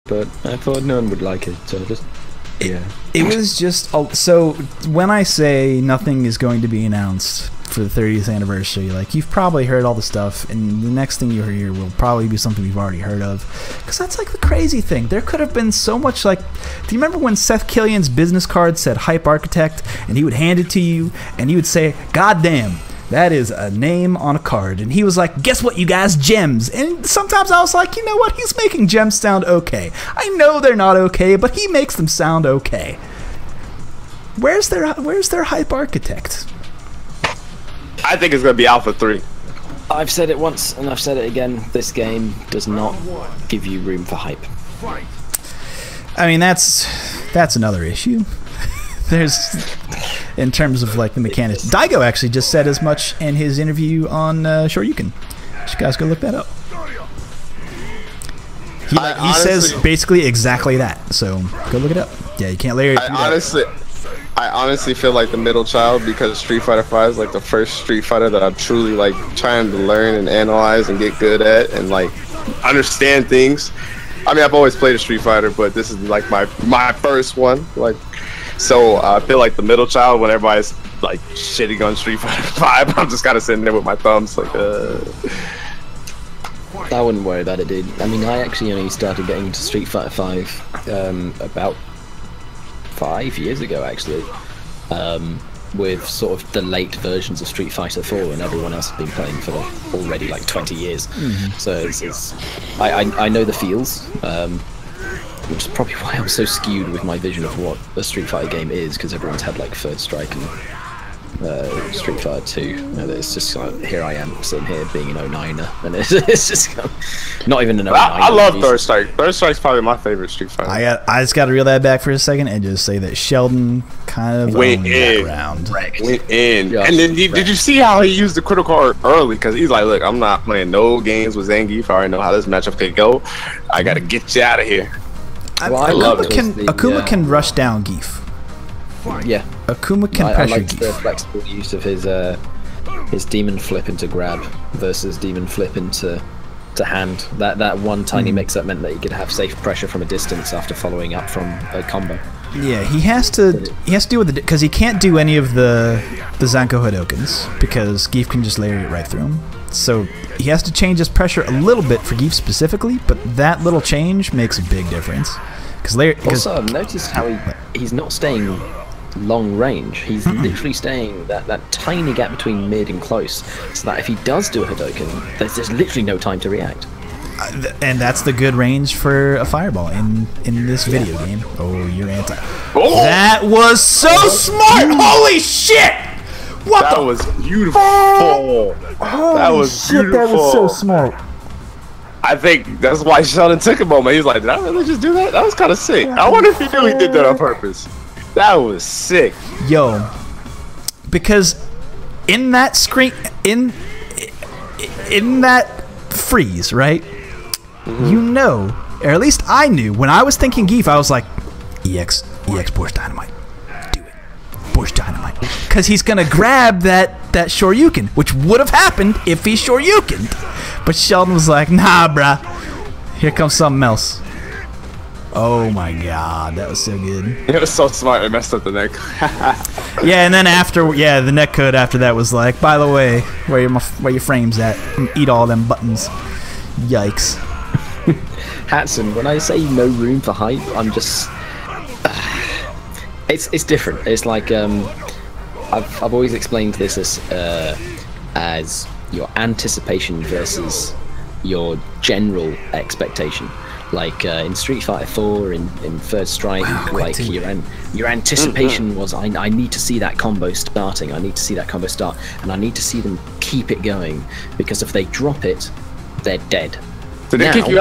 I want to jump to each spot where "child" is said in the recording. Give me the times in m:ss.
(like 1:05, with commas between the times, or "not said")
1:05, 1:19.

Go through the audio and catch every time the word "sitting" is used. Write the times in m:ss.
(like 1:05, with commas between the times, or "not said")
1:23, 1:54.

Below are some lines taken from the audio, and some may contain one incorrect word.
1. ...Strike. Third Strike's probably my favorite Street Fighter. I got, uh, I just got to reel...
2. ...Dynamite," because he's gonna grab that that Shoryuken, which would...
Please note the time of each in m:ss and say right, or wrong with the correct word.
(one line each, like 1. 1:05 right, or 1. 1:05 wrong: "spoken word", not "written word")
1. 1:58 right
2. 3:34 right.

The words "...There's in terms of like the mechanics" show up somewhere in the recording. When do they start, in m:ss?
0:49.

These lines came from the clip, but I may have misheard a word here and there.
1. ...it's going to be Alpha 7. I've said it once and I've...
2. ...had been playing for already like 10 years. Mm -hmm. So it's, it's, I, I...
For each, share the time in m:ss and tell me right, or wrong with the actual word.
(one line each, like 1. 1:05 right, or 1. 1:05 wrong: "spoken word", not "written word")
1. 0:38 wrong: "3", not "7"
2. 1:38 wrong: "20", not "10".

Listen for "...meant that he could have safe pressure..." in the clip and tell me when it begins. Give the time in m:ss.
2:28.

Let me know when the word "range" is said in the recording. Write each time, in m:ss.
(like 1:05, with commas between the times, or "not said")
2:49, 2:58.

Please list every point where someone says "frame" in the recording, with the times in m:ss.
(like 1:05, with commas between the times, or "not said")
3:54.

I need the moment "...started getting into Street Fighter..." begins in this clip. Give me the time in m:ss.
1:28.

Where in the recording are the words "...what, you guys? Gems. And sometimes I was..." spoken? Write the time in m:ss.
0:25.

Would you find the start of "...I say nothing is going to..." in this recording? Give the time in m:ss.
0:05.